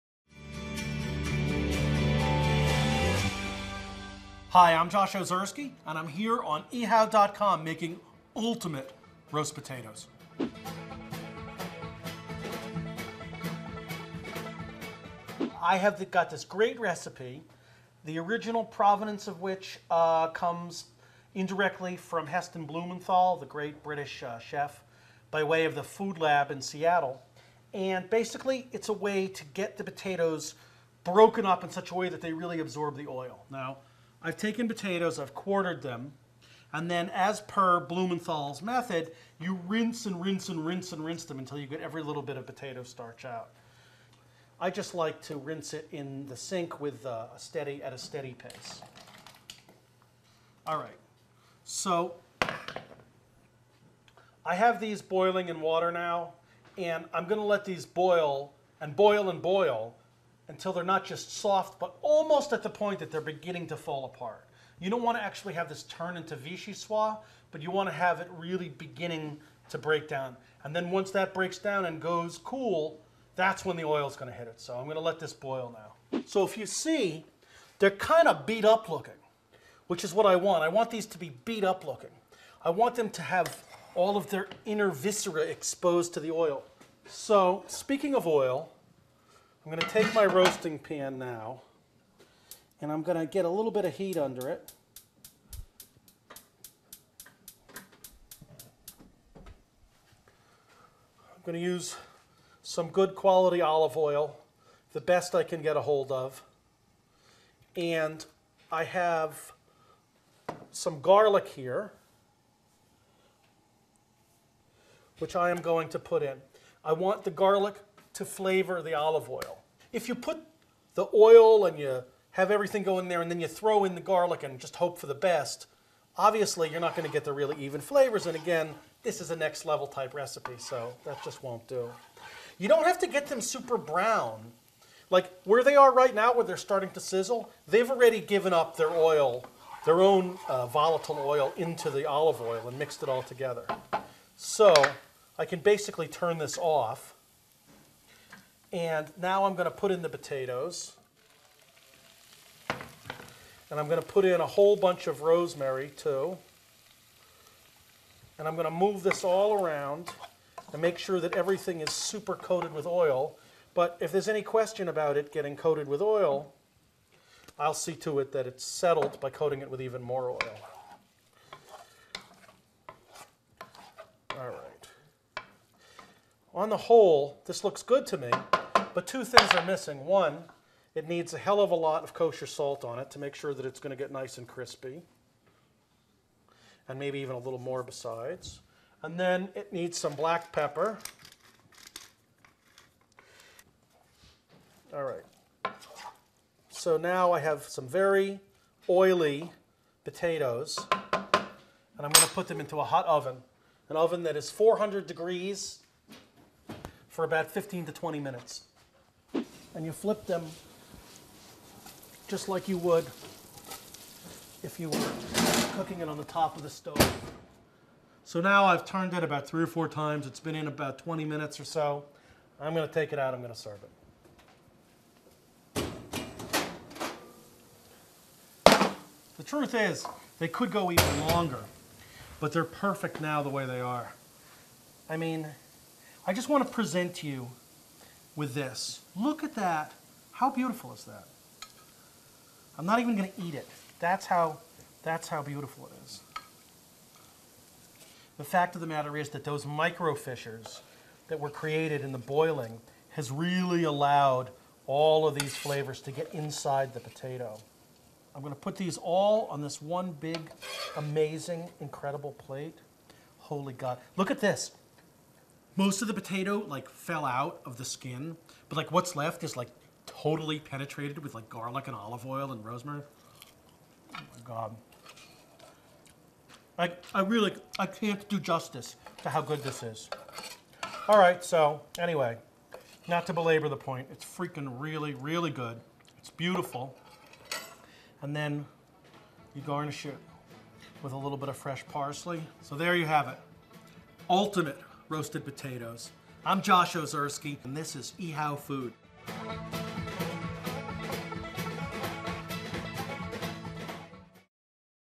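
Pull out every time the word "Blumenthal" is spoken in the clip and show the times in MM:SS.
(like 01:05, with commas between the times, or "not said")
00:22, 00:37.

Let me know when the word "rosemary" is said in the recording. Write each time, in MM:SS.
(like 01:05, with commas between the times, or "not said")
02:35, 04:32.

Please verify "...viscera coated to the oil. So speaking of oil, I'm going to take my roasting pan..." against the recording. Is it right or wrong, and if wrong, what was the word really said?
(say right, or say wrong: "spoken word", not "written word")
wrong: "exposed", not "coated".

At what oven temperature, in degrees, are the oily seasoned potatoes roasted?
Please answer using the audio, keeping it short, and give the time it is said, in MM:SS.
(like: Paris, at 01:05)
400 degrees, at 03:24.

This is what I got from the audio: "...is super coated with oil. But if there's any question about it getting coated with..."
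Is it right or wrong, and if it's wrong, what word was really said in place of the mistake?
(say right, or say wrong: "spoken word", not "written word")
right.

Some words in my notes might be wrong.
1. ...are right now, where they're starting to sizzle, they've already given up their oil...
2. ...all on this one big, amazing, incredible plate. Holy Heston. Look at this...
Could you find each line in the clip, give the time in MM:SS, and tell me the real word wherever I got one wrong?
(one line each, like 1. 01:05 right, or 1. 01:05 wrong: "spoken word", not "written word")
1. 02:15 right
2. 04:18 wrong: "God", not "Heston".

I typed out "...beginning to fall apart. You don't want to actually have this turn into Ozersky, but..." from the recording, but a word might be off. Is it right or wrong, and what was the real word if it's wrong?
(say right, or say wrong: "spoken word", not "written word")
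wrong: "Vichyssoise", not "Ozersky".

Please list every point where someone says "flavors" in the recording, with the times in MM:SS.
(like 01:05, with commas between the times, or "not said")
01:58, 02:07, 04:15.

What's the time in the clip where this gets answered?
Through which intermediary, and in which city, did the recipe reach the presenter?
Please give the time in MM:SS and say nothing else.
00:25.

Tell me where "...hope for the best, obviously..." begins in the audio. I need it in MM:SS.
02:04.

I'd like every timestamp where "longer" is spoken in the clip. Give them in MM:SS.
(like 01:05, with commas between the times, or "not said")
03:51.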